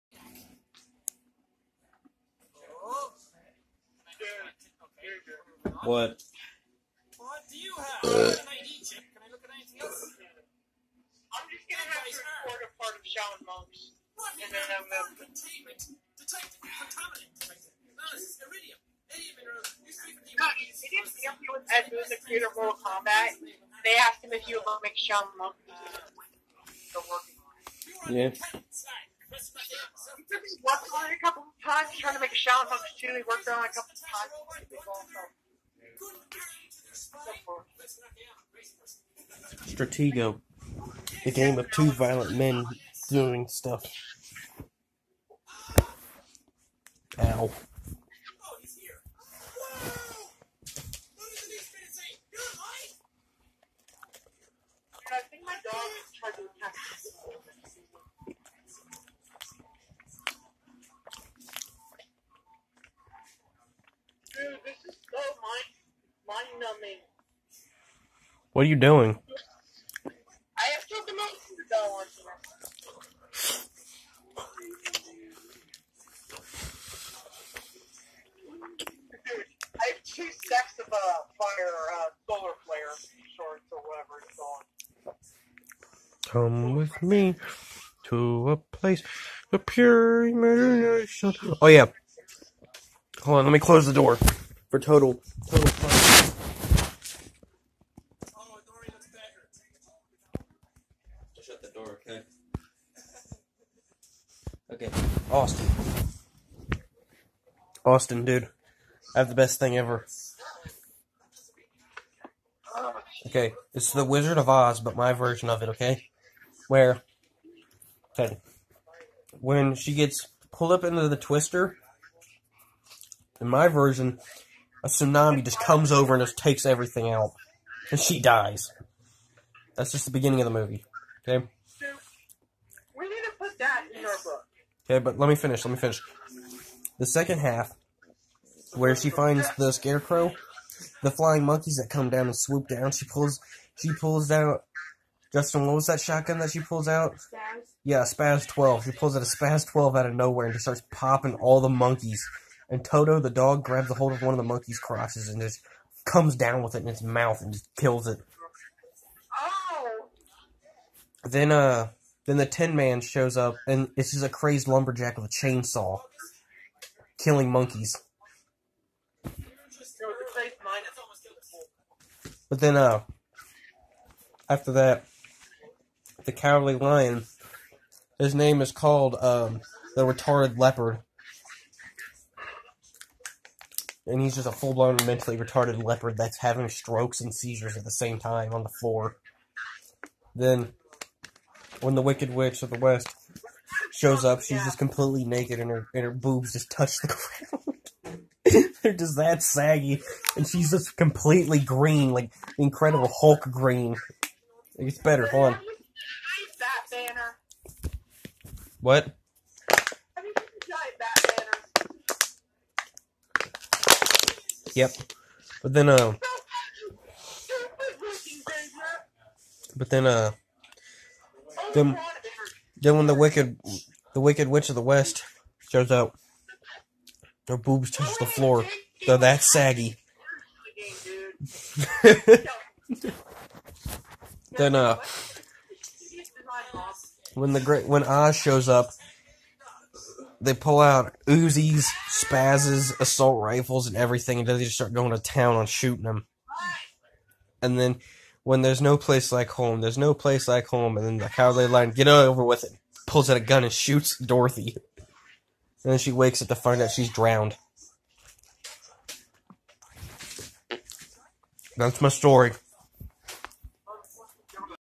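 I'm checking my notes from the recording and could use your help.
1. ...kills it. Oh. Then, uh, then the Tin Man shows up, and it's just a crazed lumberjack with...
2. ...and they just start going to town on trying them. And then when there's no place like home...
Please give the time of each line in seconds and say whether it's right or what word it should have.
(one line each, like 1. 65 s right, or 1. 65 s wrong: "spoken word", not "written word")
1. 157 s right
2. 244 s wrong: "shooting", not "trying".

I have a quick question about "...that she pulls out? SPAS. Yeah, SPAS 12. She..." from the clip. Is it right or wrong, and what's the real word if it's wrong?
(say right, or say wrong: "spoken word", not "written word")
right.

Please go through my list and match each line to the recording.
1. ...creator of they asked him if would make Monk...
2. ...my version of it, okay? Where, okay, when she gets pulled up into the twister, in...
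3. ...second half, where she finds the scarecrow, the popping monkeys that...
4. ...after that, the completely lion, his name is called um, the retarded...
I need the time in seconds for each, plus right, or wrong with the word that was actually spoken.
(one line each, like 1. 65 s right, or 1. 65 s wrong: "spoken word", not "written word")
1. 22 s right
2. 114 s right
3. 137 s wrong: "flying", not "popping"
4. 174 s wrong: "cowardly", not "completely".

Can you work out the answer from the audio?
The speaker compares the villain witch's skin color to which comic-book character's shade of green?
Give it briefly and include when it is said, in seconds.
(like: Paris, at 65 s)
Incredible Hulk, at 202 s.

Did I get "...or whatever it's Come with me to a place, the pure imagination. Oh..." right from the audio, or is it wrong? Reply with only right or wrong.
right.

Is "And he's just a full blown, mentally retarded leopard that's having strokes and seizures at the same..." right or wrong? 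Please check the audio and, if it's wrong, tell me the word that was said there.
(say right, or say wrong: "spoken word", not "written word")
right.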